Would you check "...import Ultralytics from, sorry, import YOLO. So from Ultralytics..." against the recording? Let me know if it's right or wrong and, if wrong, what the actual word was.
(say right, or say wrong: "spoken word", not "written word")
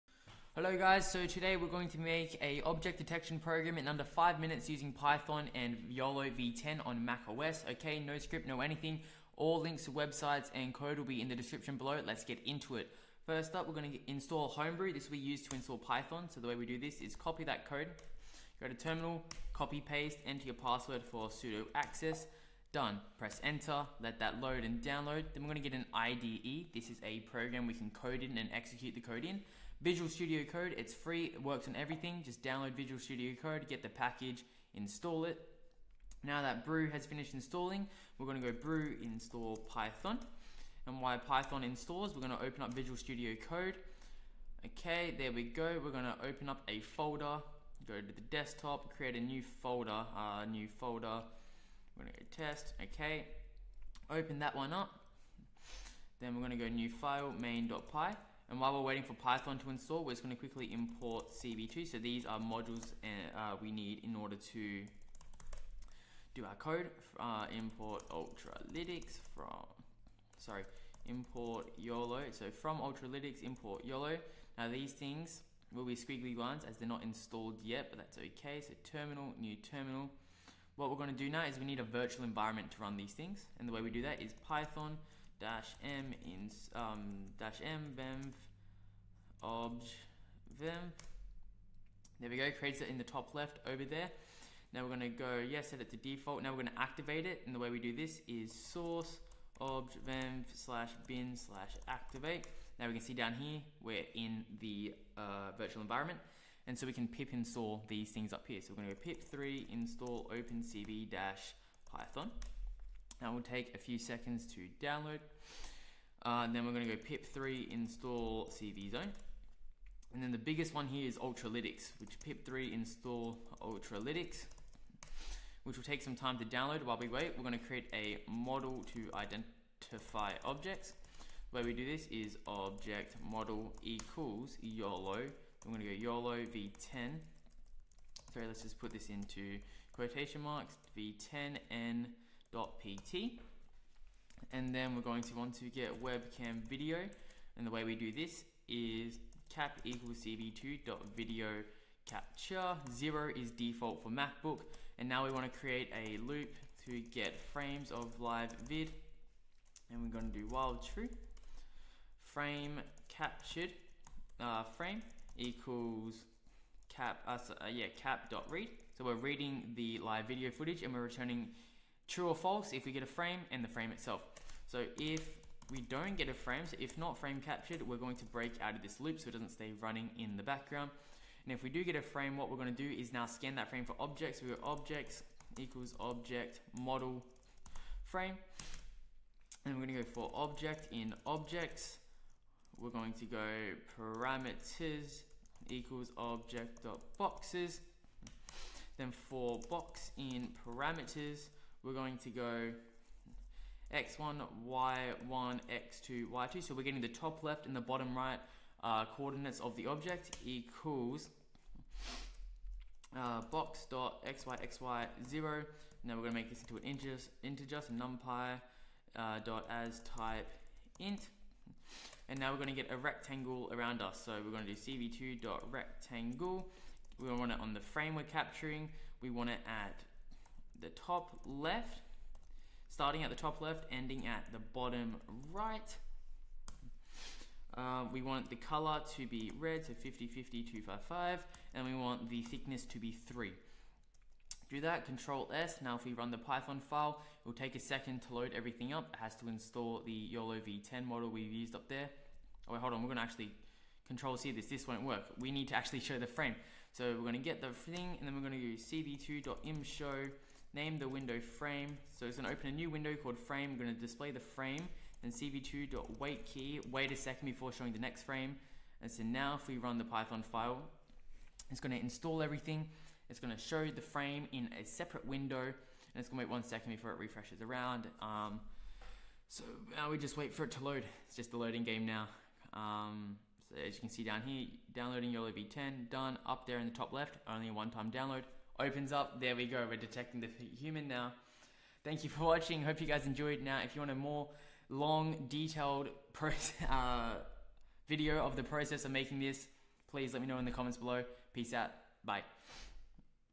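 right.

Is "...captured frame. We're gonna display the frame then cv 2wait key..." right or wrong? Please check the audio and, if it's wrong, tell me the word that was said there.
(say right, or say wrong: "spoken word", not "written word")
wrong: "called", not "captured".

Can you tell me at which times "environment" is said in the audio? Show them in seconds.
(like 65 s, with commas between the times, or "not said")
82 s, 105 s.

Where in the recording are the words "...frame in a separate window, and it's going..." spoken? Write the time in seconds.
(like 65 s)
274 s.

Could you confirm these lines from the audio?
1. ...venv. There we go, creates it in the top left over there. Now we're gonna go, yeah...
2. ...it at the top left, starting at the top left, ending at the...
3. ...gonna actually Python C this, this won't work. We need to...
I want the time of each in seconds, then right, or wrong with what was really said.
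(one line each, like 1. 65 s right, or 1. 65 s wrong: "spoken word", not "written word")
1. 90 s right
2. 229 s right
3. 253 s wrong: "Control", not "Python".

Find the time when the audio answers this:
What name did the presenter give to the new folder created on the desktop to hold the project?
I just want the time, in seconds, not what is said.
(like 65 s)
52 s.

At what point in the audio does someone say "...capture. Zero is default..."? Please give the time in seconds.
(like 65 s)
152 s.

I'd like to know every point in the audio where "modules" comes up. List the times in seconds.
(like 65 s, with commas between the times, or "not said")
62 s.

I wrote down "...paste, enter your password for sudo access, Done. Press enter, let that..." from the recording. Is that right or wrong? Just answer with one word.
right.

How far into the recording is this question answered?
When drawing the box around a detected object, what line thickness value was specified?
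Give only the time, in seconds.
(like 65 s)
243 s.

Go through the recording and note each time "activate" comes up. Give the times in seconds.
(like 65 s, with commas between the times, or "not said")
96 s, 101 s.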